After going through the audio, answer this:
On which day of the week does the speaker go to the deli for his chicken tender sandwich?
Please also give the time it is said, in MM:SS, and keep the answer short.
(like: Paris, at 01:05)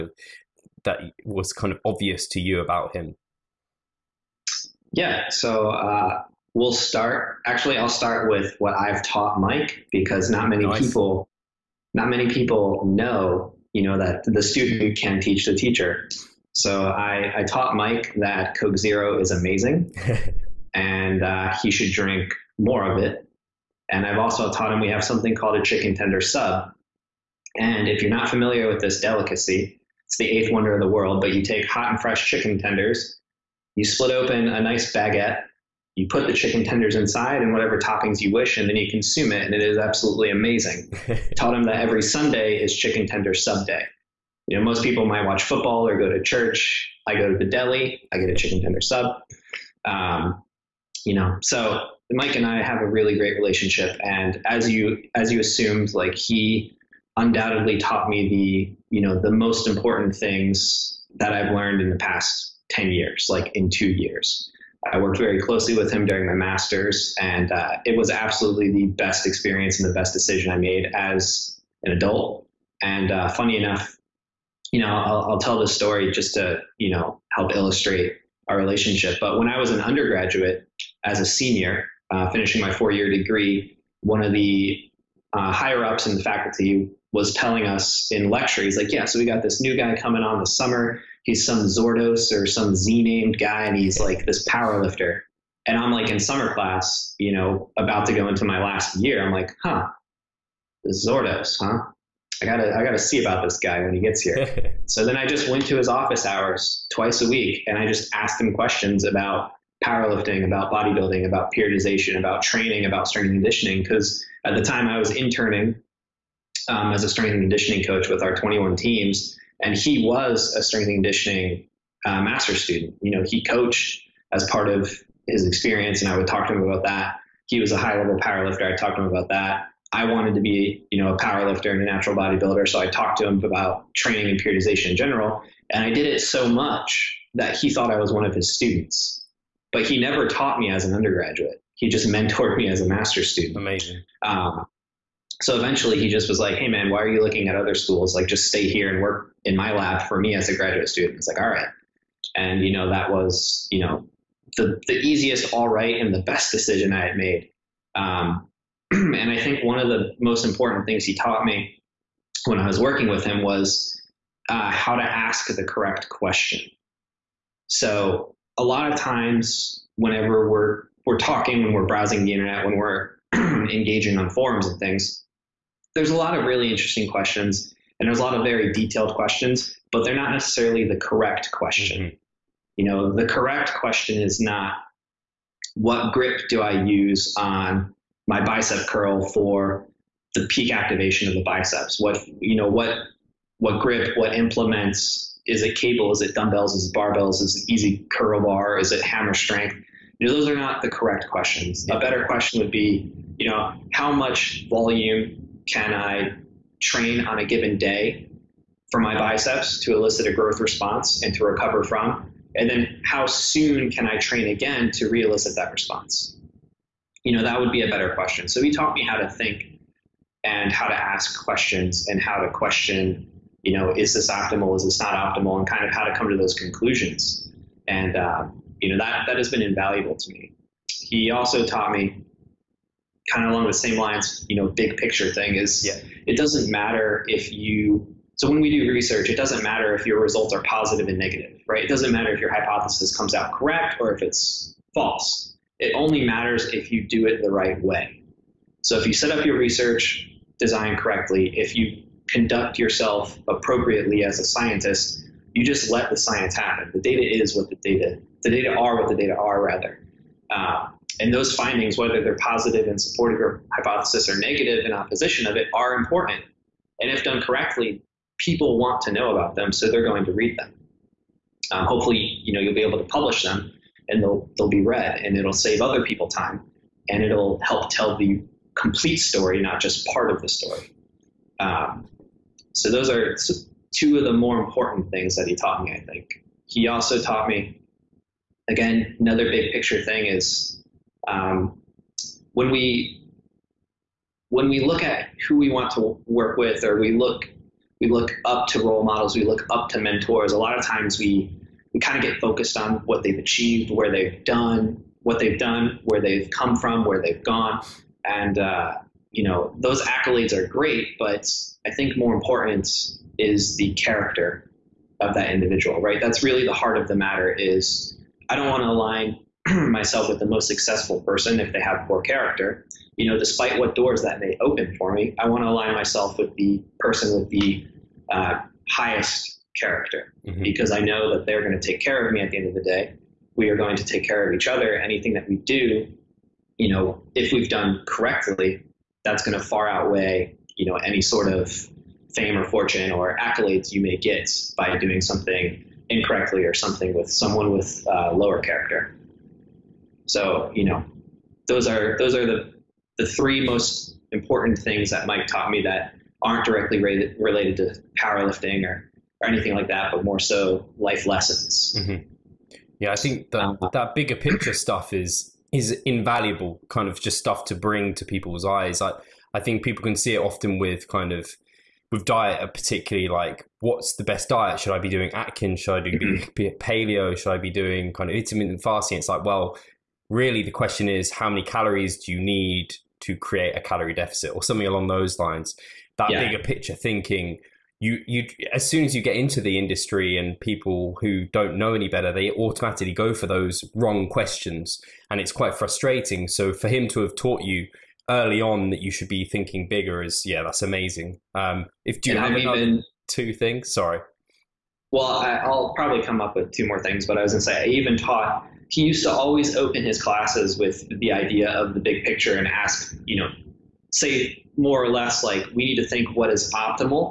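Sunday, at 00:42.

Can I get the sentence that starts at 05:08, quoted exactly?
And, uh, you know, those accolades are great, but I think more important is the character of that individual, right?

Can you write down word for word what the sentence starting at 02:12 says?
So I talked to him about training and periodization in general.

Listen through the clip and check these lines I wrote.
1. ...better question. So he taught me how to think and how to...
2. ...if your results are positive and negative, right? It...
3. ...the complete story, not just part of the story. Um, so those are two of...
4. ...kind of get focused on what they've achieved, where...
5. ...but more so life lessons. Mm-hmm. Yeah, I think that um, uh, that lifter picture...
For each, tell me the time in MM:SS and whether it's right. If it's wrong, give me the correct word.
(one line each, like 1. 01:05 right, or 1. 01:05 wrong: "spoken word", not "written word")
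1. 03:37 right
2. 03:59 right
3. 04:38 right
4. 05:02 right
5. 06:00 wrong: "bigger", not "lifter".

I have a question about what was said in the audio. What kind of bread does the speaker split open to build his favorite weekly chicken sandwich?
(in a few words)
baguette.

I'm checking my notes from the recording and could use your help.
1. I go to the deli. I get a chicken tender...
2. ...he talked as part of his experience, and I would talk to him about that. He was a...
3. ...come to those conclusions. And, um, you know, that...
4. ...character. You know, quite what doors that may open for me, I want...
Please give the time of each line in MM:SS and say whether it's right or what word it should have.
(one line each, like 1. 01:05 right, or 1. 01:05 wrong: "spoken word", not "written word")
1. 00:47 right
2. 02:03 wrong: "coached", not "talked"
3. 03:46 right
4. 05:22 wrong: "despite", not "quite".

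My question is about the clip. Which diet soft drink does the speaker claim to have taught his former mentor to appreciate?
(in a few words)
Coke Zero.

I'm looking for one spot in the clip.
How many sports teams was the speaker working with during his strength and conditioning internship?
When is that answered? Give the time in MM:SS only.
01:58.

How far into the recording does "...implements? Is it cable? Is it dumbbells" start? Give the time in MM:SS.
03:14.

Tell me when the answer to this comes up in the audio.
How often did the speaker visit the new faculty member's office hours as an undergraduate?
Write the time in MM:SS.
01:46.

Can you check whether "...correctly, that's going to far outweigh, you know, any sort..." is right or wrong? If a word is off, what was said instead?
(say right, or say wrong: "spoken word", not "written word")
right.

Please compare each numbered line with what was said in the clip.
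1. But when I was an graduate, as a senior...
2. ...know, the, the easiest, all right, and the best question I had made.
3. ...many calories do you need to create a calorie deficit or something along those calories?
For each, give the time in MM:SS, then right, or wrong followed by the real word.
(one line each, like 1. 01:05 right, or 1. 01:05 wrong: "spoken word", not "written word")
1. 01:19 wrong: "undergraduate", not "graduate"
2. 02:33 wrong: "decision", not "question"
3. 06:21 wrong: "lines", not "calories".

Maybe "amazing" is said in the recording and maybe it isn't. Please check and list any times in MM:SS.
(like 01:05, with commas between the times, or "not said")
00:19, 00:40, 02:23, 06:40.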